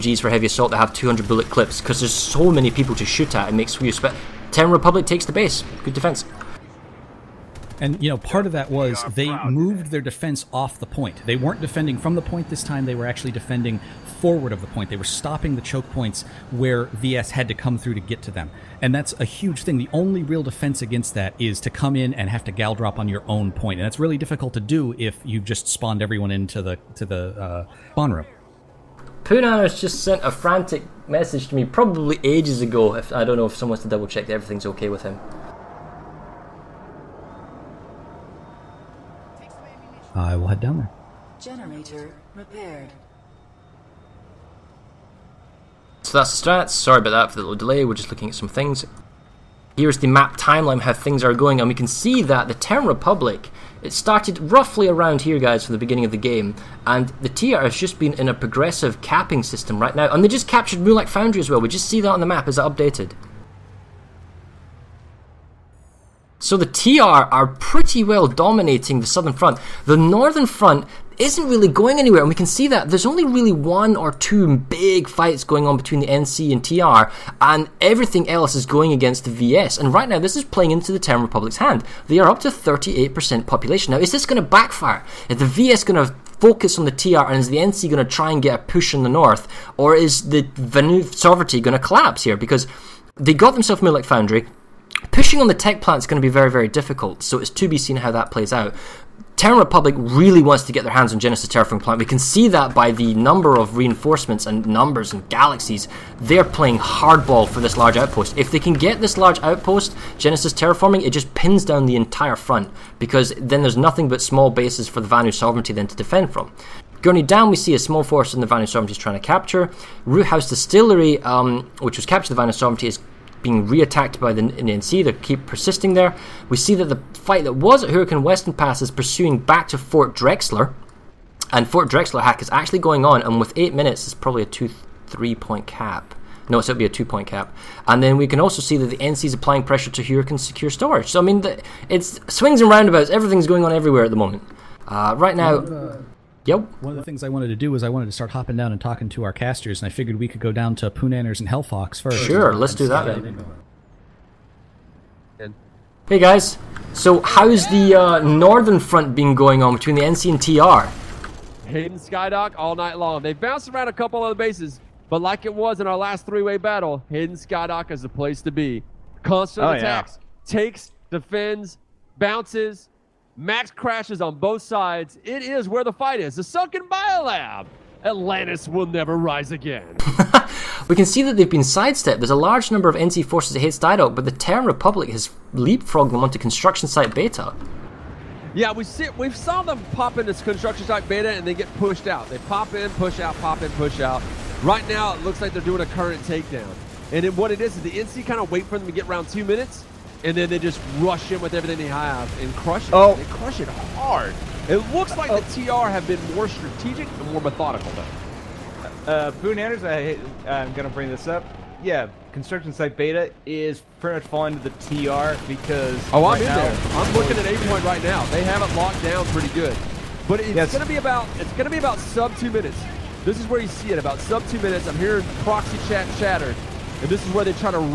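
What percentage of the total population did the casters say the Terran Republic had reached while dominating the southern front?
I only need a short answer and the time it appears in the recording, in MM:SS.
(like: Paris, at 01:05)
38%, at 01:22.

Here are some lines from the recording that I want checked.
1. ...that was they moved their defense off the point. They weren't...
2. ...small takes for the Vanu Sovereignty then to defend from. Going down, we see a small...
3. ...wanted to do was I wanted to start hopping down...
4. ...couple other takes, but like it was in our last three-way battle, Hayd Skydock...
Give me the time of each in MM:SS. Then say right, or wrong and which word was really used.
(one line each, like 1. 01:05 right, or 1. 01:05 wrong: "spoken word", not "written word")
1. 00:08 right
2. 01:54 wrong: "bases", not "takes"
3. 02:27 right
4. 02:43 wrong: "bases", not "takes".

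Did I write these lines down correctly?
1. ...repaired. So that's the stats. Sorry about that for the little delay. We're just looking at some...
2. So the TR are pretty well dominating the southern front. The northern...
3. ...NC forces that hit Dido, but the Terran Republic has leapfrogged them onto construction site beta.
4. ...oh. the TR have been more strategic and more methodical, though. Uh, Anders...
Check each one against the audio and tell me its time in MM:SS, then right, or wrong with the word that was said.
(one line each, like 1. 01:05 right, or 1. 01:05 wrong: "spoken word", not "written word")
1. 00:42 right
2. 01:06 right
3. 03:02 right
4. 03:25 wrong: "Boone", not "Anders".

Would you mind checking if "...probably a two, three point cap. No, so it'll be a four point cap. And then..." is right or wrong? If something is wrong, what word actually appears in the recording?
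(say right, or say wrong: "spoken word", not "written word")
wrong: "two", not "four".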